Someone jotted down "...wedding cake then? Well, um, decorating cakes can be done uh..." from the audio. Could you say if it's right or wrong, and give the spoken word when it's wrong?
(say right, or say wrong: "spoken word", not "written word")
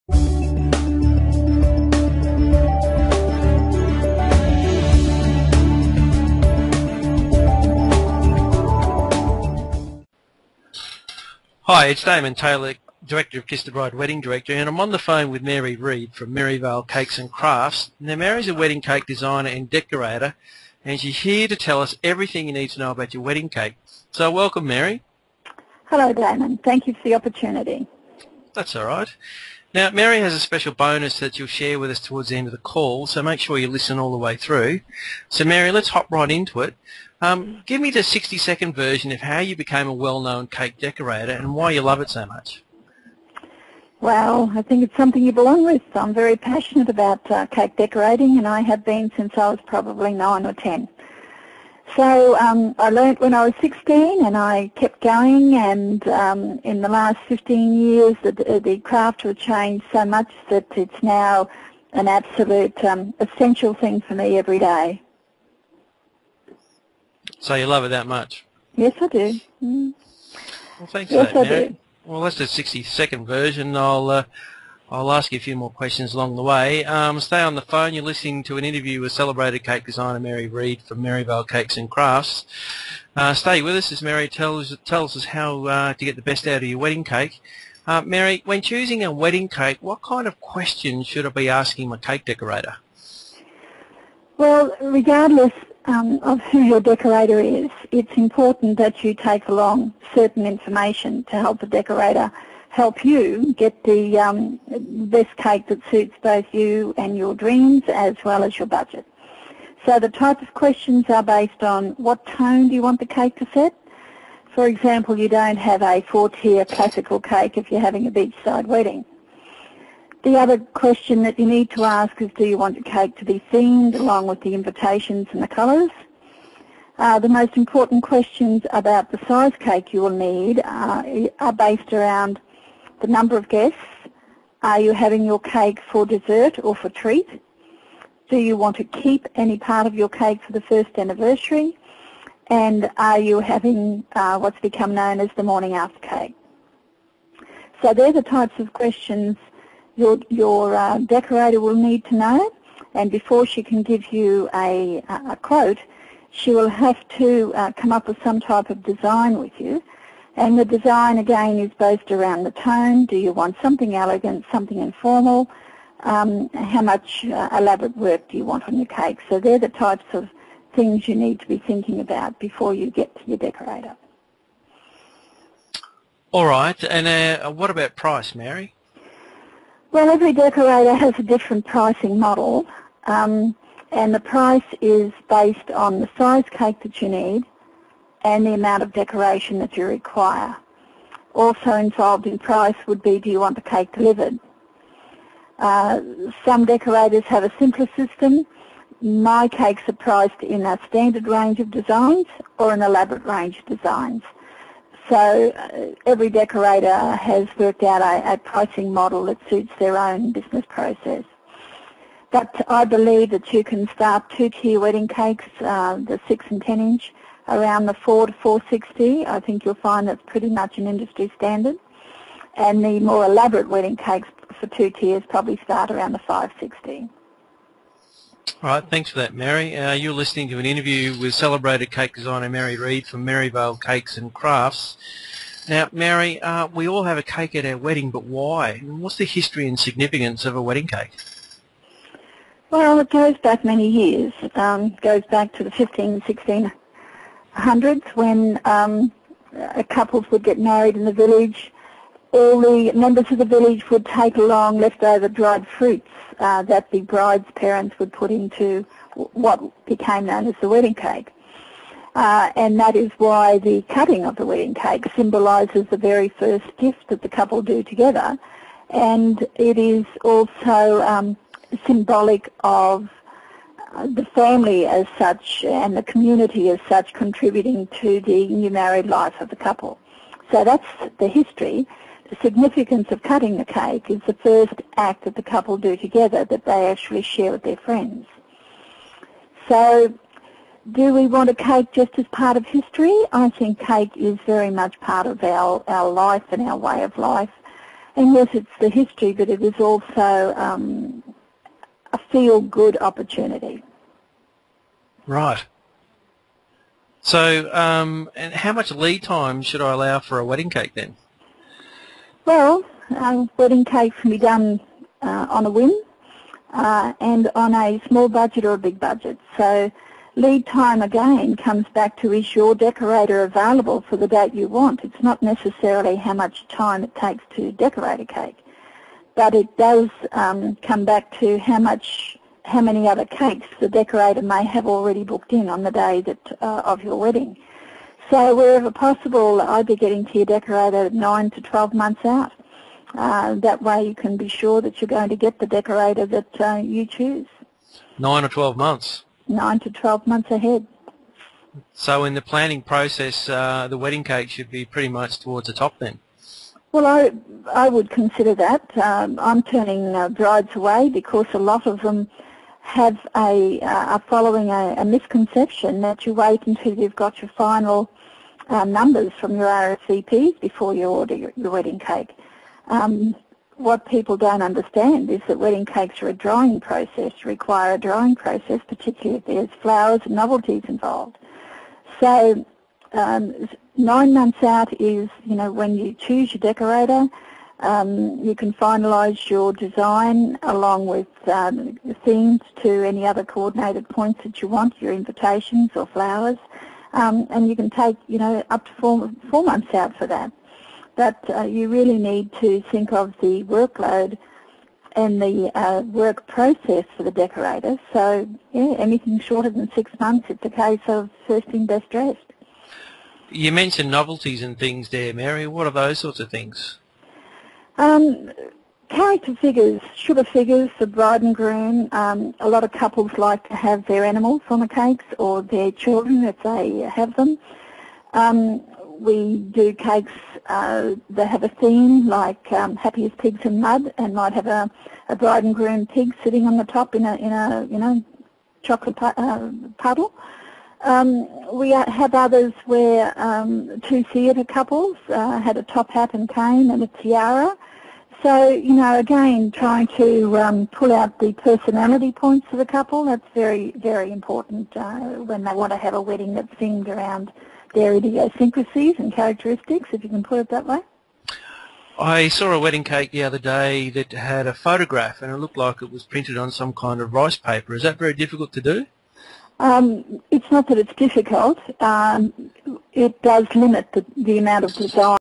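wrong: "wedding", not "decorating".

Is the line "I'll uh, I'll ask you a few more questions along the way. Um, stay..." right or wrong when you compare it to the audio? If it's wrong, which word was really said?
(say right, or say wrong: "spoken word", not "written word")
right.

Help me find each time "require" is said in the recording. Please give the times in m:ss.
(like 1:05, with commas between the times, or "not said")
3:09, 6:17.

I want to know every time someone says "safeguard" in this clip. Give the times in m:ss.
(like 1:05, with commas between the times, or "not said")
not said.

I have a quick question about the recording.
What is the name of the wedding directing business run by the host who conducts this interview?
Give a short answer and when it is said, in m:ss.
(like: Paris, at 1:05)
Kiss the Bride Wedding Director, at 0:13.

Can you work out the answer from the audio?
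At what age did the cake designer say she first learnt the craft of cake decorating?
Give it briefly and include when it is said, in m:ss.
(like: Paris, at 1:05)
16, at 0:53.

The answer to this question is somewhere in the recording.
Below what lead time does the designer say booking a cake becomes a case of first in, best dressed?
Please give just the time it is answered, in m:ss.
6:49.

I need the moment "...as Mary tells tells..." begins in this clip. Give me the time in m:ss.
1:23.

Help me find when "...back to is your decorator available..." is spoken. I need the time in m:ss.
5:21.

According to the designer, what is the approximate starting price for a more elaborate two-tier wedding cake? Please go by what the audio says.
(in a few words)
560.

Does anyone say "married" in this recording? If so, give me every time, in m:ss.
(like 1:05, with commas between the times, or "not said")
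4:10, 4:38.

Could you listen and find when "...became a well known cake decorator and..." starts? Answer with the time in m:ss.
0:39.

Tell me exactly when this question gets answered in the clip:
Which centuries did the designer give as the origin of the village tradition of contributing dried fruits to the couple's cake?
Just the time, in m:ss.
4:05.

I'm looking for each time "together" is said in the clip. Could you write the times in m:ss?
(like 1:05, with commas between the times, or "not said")
4:27, 4:45.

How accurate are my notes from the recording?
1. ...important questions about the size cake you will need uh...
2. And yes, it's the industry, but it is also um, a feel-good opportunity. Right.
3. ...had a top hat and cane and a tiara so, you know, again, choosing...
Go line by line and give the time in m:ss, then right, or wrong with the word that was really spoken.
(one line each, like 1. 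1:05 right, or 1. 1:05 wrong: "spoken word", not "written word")
1. 2:07 right
2. 4:58 wrong: "history", not "industry"
3. 7:25 wrong: "trying", not "choosing".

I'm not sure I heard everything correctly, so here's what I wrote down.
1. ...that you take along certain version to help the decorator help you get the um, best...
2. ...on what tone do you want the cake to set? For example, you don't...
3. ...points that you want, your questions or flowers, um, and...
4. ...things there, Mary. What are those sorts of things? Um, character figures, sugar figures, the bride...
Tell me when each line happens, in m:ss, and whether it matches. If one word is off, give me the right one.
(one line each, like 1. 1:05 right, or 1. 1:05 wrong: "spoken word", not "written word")
1. 1:38 wrong: "information", not "version"
2. 1:51 right
3. 6:34 wrong: "invitations", not "questions"
4. 6:54 right.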